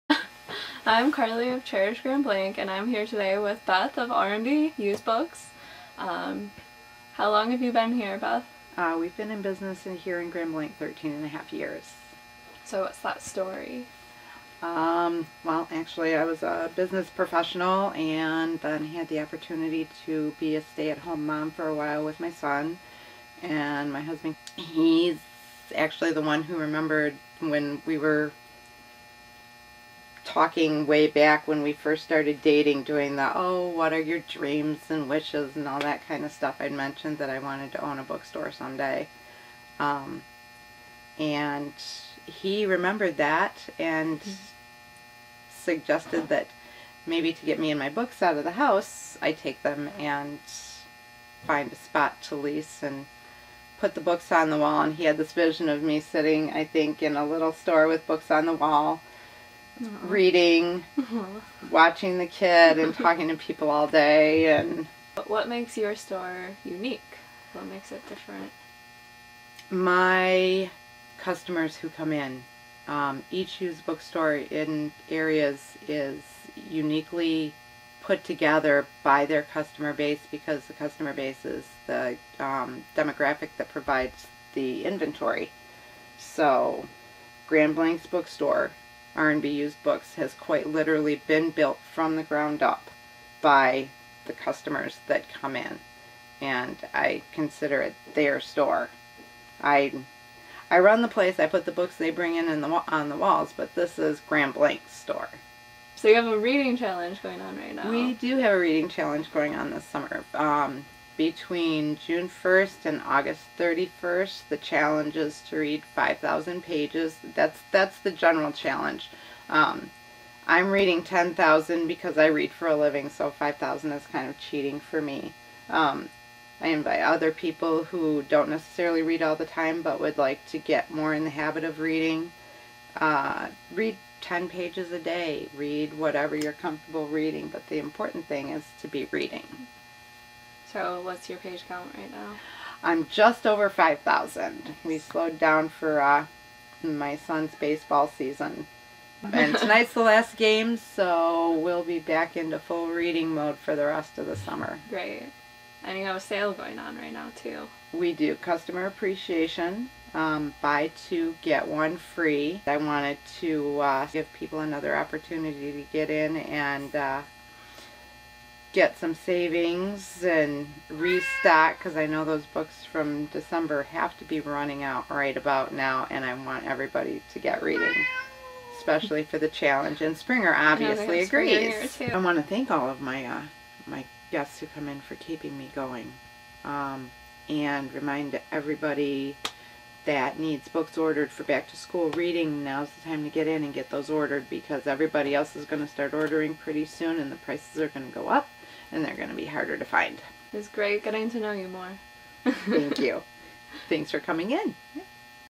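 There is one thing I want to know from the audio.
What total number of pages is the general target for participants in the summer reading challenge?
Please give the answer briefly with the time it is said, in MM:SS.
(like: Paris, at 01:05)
5,000, at 01:55.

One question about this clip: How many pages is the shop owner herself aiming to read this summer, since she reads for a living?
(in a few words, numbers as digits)
10,000.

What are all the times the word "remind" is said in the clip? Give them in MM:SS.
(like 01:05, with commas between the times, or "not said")
03:07.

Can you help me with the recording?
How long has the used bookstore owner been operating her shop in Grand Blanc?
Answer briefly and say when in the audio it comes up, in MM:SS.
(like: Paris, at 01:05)
13 and a half years, at 00:10.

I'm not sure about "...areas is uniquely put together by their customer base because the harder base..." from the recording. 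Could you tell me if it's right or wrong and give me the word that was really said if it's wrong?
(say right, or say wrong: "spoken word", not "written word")
wrong: "customer", not "harder".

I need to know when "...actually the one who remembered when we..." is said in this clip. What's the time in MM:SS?
00:25.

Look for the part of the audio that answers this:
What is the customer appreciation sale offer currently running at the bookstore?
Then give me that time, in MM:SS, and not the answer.
02:40.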